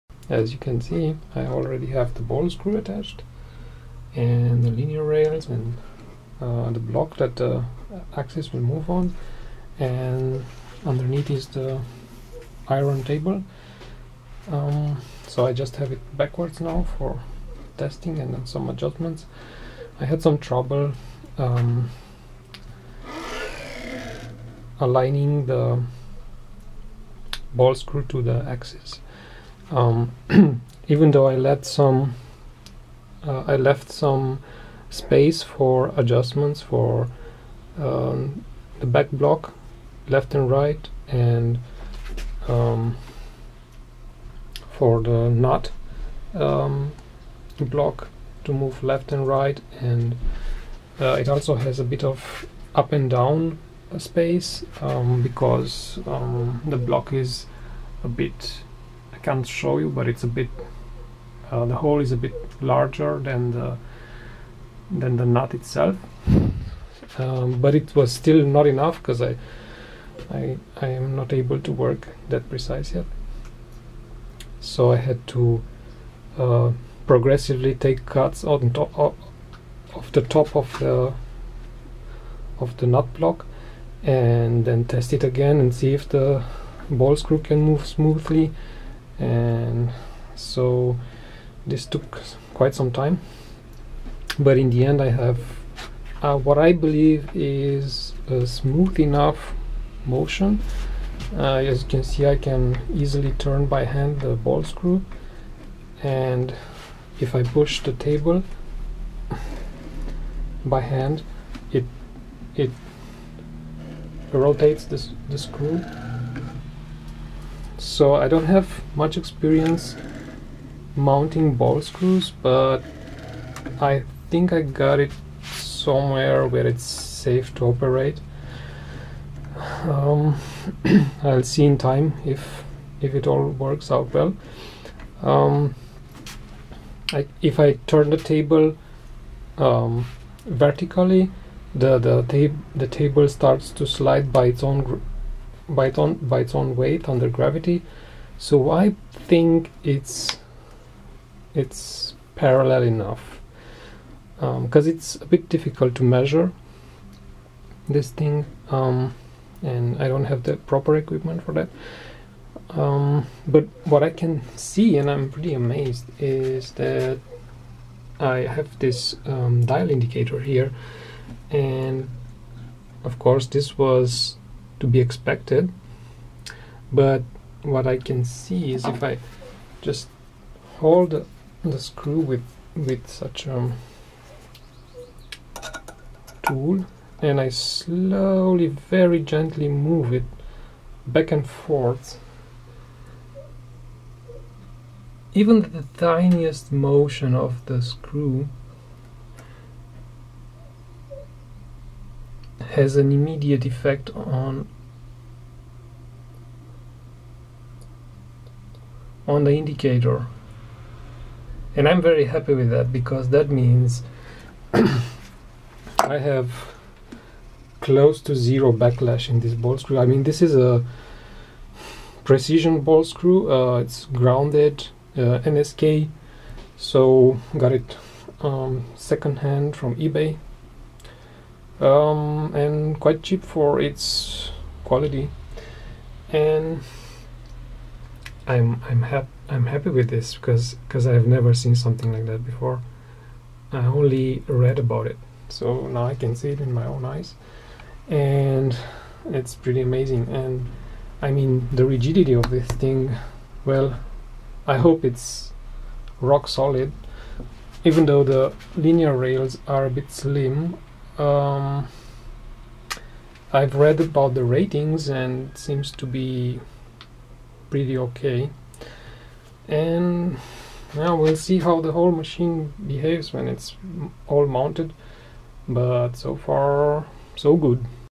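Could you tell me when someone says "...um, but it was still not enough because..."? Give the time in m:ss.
1:07.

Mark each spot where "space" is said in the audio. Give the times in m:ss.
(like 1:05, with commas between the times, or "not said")
0:34, 0:53.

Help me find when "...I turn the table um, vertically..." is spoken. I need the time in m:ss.
2:17.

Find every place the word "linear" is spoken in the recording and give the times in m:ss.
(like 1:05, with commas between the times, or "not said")
0:04, 4:18.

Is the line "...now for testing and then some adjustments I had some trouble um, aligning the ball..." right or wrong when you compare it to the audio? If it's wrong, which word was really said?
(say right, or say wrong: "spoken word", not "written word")
right.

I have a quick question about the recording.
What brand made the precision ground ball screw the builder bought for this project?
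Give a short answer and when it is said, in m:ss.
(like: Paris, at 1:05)
NSK, at 3:45.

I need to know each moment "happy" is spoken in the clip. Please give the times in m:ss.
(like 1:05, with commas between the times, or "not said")
3:32, 3:59.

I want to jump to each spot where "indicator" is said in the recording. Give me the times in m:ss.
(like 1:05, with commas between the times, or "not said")
2:49, 3:29.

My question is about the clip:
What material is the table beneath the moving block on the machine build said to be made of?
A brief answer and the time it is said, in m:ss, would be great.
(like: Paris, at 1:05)
Iron, at 0:12.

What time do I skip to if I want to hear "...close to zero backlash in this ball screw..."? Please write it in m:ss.
3:37.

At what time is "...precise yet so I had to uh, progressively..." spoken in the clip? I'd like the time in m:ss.
1:12.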